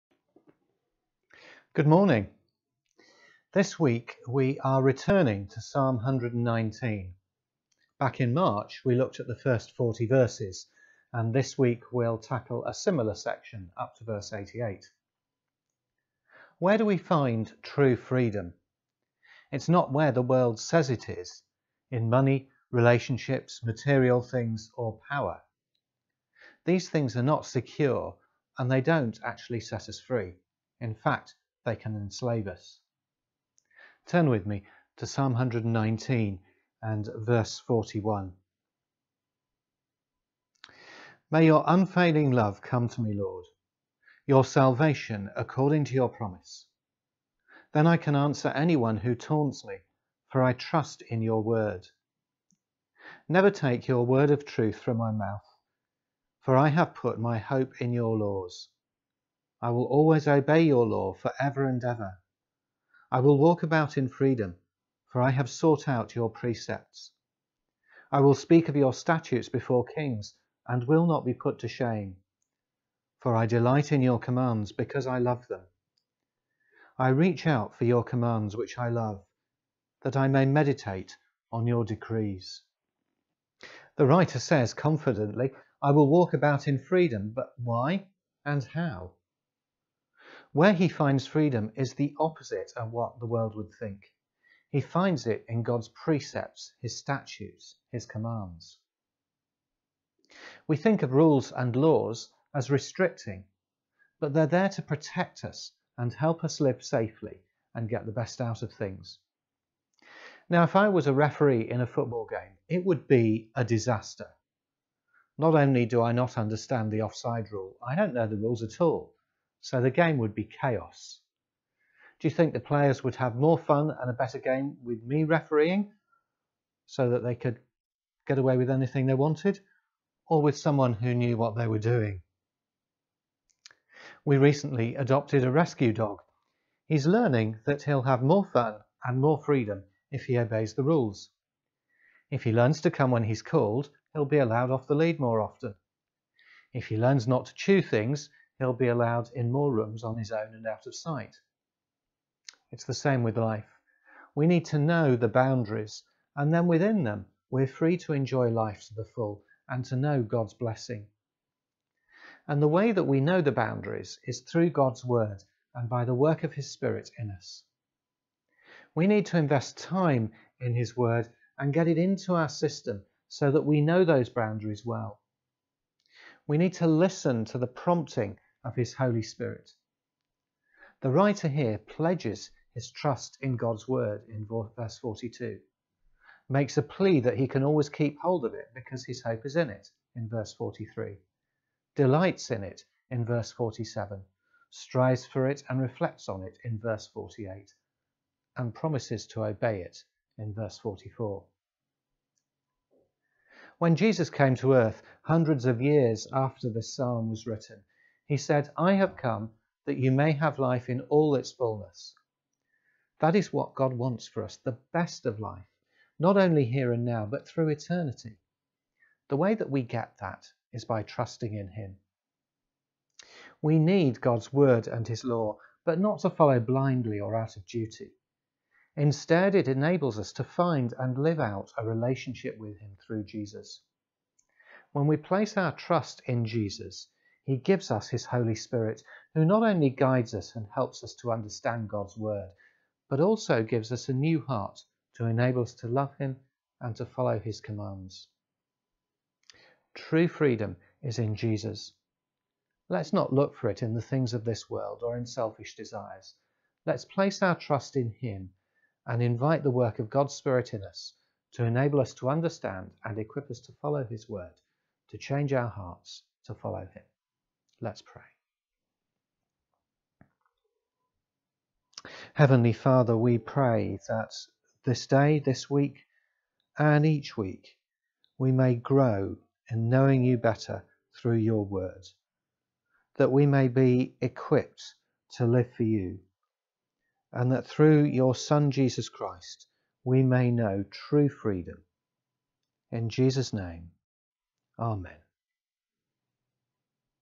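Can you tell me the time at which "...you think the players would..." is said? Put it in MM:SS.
02:02.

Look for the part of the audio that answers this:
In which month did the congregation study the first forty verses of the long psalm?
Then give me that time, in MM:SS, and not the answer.
00:08.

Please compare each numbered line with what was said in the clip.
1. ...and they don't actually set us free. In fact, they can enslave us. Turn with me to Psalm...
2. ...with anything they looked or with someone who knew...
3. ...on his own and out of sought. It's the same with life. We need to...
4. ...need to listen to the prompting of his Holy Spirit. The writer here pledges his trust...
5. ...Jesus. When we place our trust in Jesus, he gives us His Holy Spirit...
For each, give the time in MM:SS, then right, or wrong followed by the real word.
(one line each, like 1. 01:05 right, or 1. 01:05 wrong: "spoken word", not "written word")
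1. 00:28 right
2. 02:08 wrong: "wanted", not "looked"
3. 02:30 wrong: "sight", not "sought"
4. 02:56 right
5. 03:53 right.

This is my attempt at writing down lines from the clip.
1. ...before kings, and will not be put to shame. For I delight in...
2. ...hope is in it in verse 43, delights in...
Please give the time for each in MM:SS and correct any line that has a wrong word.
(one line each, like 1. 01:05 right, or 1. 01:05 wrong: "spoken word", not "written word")
1. 01:09 right
2. 03:09 right.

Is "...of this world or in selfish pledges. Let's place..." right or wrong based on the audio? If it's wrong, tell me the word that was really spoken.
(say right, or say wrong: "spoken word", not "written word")
wrong: "desires", not "pledges".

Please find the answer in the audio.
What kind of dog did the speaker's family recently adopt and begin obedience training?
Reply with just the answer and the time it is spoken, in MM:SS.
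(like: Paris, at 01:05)
Rescue dog, at 02:15.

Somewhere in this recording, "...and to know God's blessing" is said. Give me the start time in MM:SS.
02:39.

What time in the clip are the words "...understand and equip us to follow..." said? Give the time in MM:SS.
04:22.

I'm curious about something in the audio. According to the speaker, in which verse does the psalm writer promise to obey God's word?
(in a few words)
44.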